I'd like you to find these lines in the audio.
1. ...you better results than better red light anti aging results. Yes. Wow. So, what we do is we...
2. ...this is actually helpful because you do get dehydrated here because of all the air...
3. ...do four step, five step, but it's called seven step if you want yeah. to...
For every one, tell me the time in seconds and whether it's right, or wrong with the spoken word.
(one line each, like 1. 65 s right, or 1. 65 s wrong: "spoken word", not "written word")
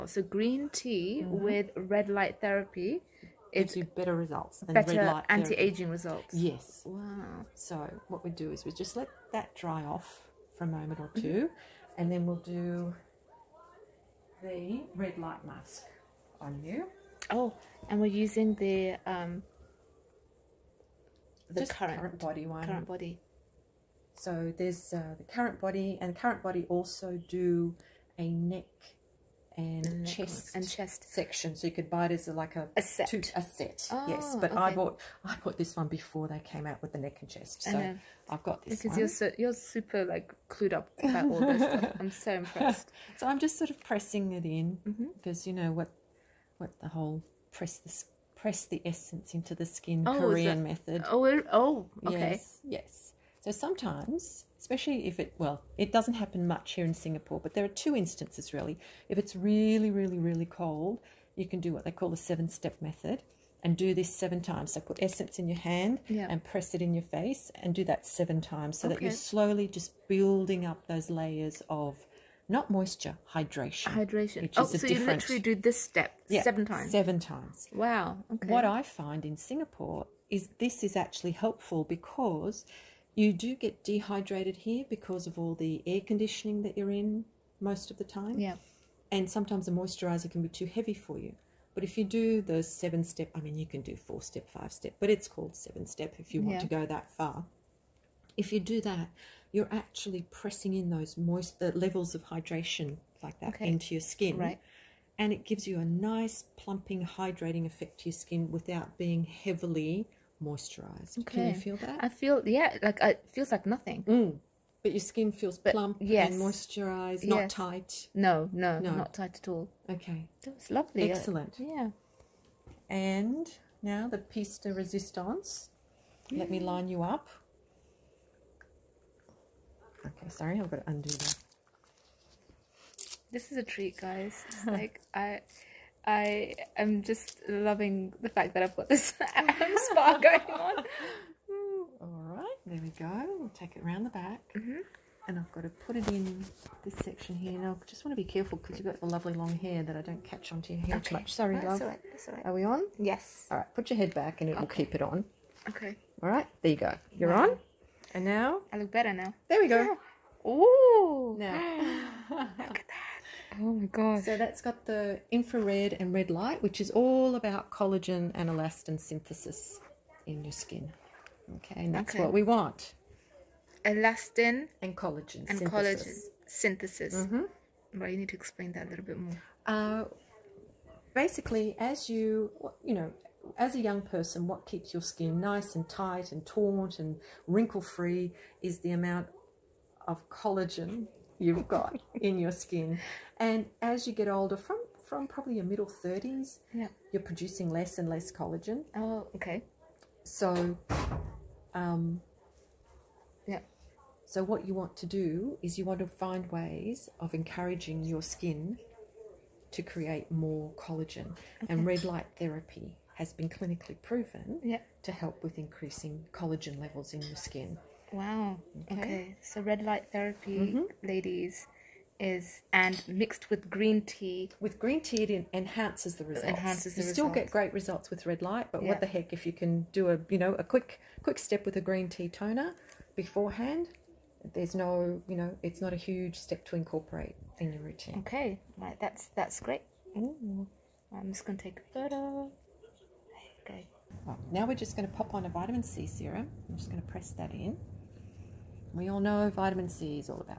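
1. 3 s right
2. 80 s right
3. 93 s right.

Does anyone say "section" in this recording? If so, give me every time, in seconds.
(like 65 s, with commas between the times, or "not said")
31 s, 147 s.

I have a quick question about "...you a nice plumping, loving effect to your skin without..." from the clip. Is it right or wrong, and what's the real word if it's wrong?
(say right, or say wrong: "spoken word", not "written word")
wrong: "hydrating", not "loving".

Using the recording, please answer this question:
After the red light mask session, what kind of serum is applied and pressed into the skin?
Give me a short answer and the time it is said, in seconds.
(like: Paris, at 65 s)
vitamin C serum, at 245 s.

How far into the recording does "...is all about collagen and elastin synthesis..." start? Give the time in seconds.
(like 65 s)
166 s.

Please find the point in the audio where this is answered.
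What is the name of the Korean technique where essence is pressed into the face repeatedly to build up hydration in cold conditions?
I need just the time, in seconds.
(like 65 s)
62 s.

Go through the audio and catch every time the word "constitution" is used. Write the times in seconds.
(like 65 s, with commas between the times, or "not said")
not said.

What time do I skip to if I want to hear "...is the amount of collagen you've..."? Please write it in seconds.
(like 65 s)
188 s.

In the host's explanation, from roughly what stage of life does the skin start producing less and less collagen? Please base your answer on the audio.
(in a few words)
middle 30s.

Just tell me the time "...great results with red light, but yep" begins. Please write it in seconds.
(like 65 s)
227 s.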